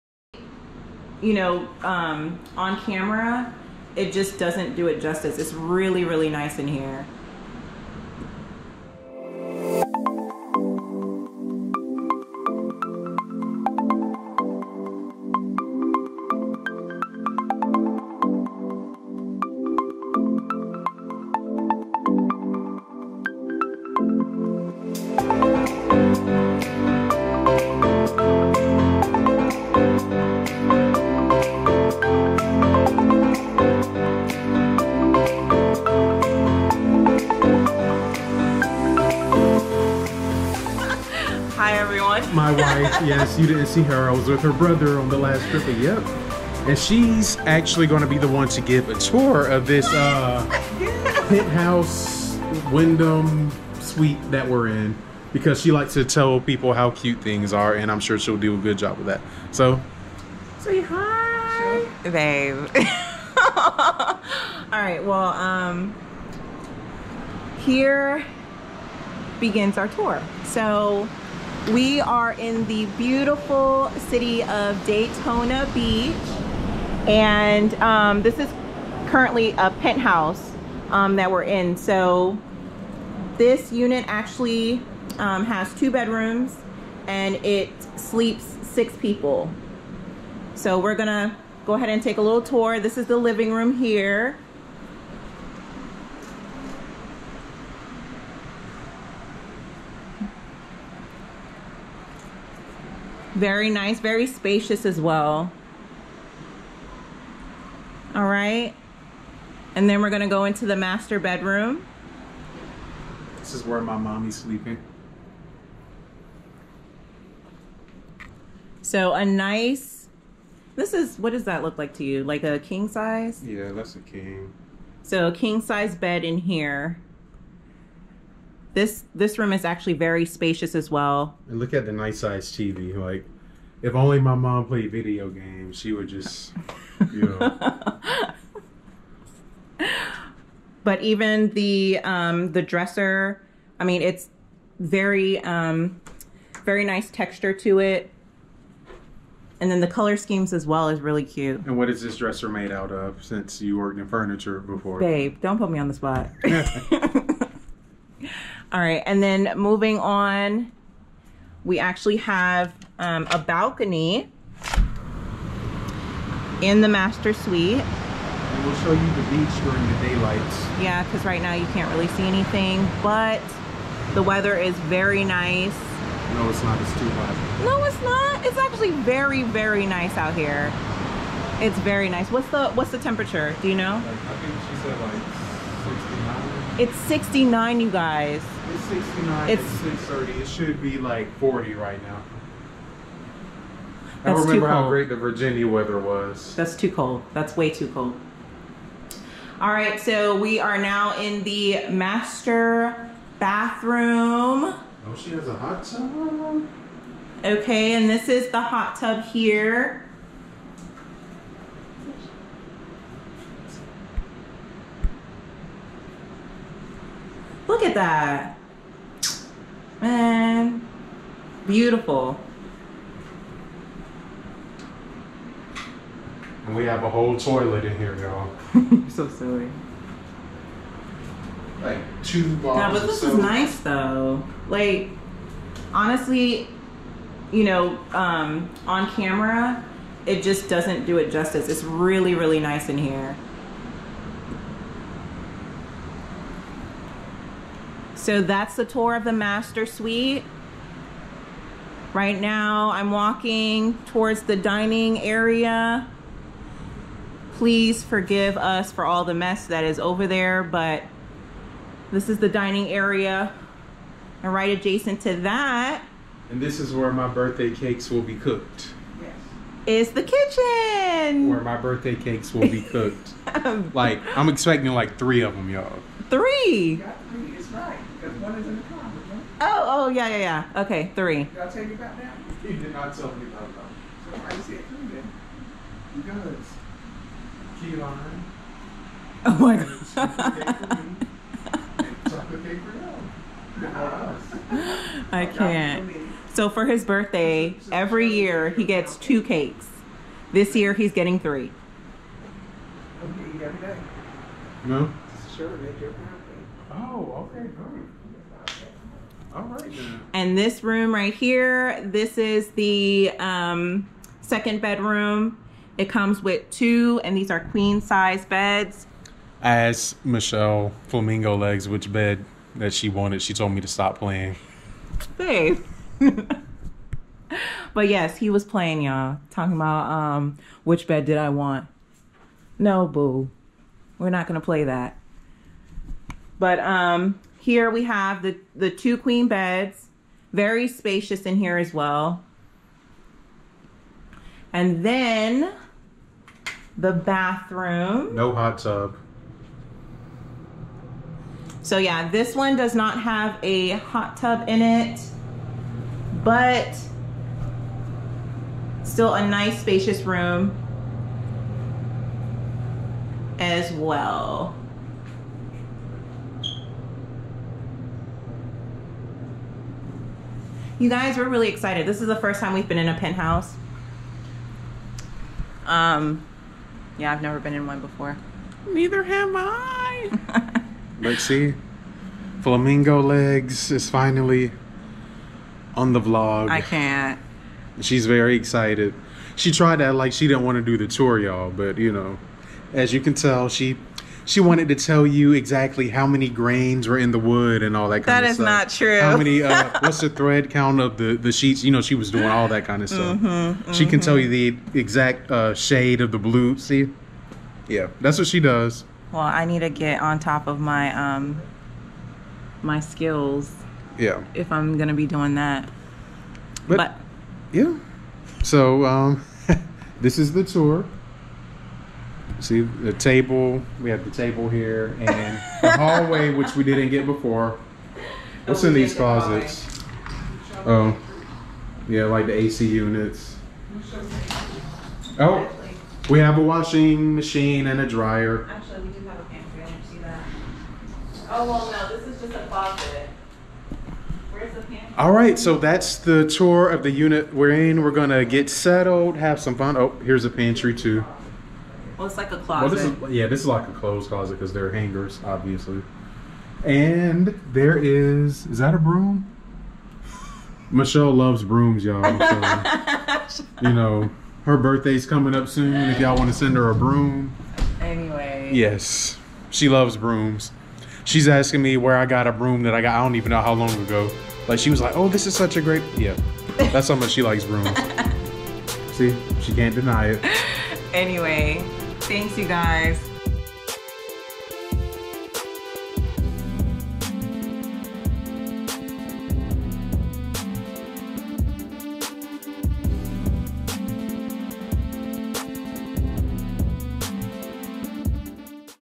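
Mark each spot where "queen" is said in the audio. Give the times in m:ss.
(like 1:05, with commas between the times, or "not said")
5:17, 5:39.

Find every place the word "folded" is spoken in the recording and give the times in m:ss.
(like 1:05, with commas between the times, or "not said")
not said.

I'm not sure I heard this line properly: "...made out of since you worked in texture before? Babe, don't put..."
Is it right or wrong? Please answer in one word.
wrong.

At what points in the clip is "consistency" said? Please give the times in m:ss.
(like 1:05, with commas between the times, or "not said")
not said.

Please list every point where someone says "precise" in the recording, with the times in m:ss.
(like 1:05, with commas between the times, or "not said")
not said.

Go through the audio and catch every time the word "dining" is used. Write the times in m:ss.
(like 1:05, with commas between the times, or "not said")
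4:14, 4:22.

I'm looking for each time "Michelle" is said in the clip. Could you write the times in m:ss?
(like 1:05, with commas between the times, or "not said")
5:20, 7:40.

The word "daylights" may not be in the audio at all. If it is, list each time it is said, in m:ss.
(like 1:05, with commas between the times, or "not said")
2:50.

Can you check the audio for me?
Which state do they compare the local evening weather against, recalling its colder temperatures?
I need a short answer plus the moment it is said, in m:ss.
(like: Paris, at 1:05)
Virginia, at 3:15.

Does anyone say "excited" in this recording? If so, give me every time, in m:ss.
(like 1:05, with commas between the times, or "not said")
6:11, 6:28.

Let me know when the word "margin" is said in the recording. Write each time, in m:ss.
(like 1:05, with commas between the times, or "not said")
not said.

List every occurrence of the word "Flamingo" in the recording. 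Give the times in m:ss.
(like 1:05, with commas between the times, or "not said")
5:21, 6:22.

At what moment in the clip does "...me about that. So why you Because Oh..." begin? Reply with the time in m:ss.
4:43.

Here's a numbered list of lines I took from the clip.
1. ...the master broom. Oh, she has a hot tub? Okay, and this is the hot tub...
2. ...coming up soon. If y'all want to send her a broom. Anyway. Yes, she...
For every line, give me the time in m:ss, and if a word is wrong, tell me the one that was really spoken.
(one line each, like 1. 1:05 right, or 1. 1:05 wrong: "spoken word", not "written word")
1. 3:21 wrong: "bathroom", not "broom"
2. 7:45 right.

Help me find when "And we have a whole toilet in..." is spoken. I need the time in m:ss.
3:46.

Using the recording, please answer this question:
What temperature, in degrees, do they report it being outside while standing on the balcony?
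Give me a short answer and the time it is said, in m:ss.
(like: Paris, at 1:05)
69, at 3:06.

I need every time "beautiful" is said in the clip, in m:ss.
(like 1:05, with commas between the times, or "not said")
1:12, 3:41.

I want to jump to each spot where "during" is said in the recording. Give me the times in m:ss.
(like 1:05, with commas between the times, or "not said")
2:49.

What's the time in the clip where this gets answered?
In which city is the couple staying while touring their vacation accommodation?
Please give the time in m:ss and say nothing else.
1:14.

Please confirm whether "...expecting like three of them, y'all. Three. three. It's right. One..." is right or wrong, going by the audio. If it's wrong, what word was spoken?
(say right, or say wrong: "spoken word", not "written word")
right.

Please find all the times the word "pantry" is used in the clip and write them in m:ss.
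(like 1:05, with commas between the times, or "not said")
7:19, 7:30.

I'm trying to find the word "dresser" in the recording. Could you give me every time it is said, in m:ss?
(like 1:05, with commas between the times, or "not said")
2:22, 2:32.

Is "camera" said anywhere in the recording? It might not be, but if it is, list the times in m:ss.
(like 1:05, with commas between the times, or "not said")
0:02, 3:59.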